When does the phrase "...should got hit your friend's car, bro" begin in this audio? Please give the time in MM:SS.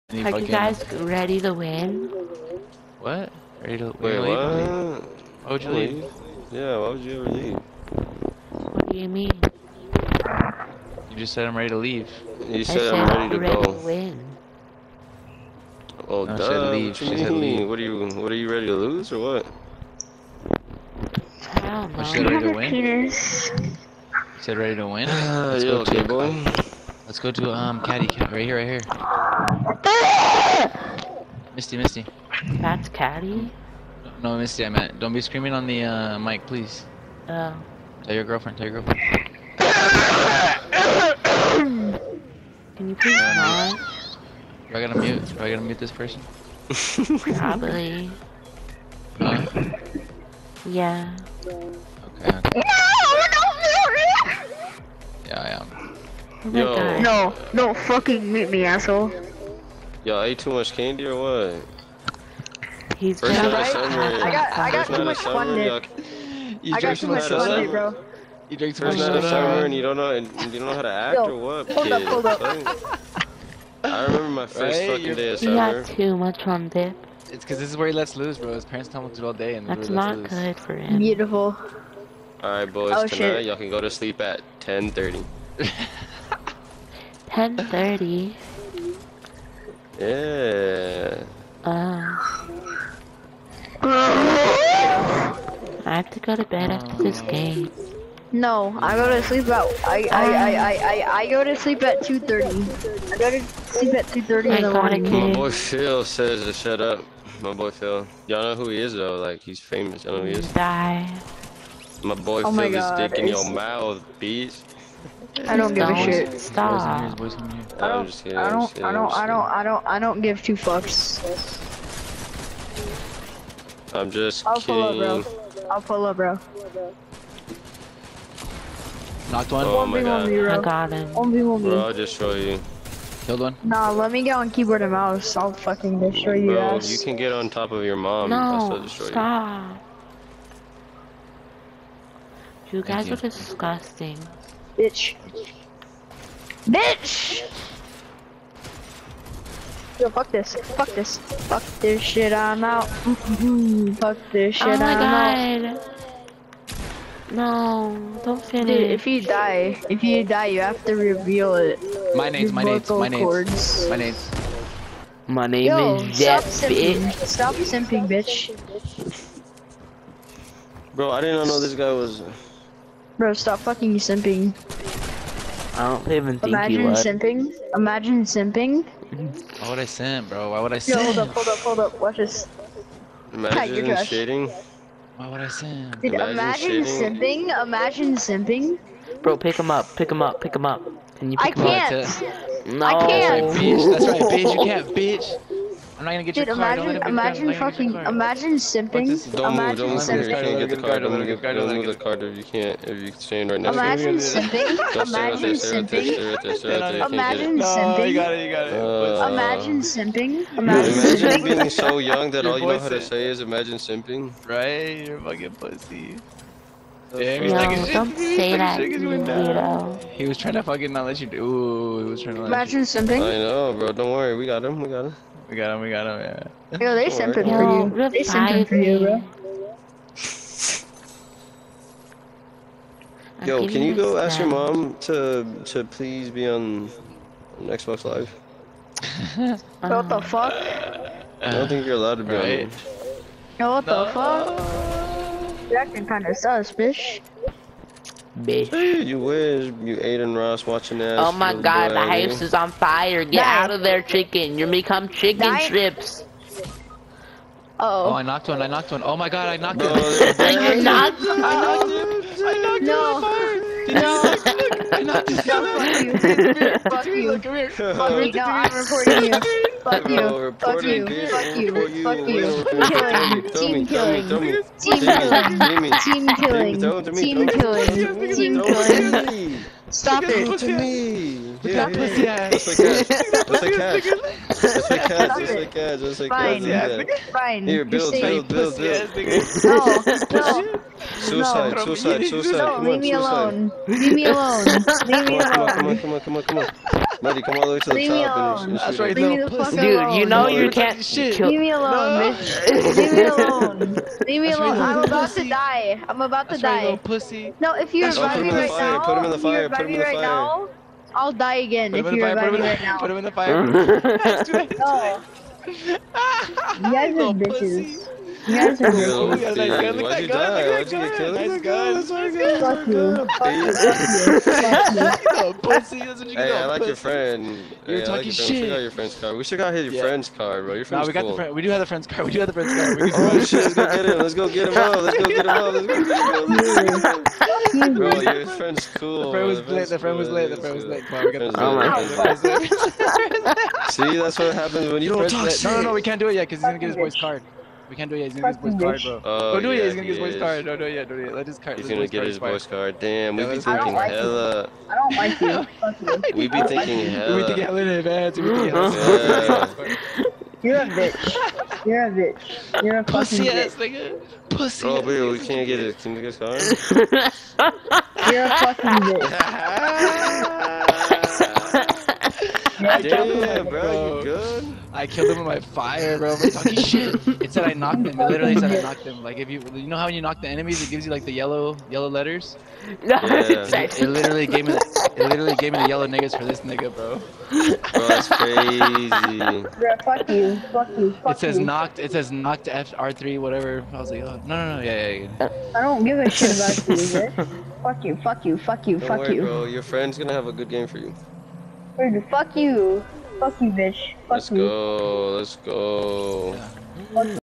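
05:29.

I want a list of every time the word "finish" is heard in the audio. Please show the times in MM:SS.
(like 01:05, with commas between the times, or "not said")
02:38.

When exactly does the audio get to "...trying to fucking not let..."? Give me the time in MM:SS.
03:40.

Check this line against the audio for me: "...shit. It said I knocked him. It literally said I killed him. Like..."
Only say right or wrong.
wrong.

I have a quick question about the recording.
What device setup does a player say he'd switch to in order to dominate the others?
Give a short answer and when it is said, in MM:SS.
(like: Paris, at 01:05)
keyboard and mouse, at 02:14.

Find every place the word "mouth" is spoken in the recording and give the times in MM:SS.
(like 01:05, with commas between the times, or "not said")
01:53.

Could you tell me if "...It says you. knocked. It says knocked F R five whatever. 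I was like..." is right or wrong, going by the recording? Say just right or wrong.
wrong.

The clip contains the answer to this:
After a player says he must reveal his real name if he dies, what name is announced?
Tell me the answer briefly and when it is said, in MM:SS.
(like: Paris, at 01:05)
Jeff, at 02:45.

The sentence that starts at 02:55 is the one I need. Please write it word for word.
I don't even think Imagine you would.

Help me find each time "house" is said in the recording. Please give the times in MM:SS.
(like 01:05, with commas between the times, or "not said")
04:12.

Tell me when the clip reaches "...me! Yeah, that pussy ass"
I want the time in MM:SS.
04:40.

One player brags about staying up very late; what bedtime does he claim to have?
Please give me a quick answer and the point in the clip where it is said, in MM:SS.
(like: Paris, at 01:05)
2:30 in the morning, at 01:44.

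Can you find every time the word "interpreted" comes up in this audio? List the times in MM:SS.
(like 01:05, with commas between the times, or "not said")
not said.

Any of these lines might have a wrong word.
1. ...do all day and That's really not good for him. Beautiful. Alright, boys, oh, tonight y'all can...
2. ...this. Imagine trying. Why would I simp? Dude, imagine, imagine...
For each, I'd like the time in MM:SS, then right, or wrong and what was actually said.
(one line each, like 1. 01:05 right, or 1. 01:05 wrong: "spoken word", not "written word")
1. 01:19 right
2. 03:02 wrong: "shading", not "trying".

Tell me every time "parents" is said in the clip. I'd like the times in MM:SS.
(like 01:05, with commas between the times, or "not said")
01:18.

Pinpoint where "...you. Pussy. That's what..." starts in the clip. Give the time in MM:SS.
05:25.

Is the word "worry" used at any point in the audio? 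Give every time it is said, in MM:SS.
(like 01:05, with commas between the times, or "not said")
03:44, 06:39.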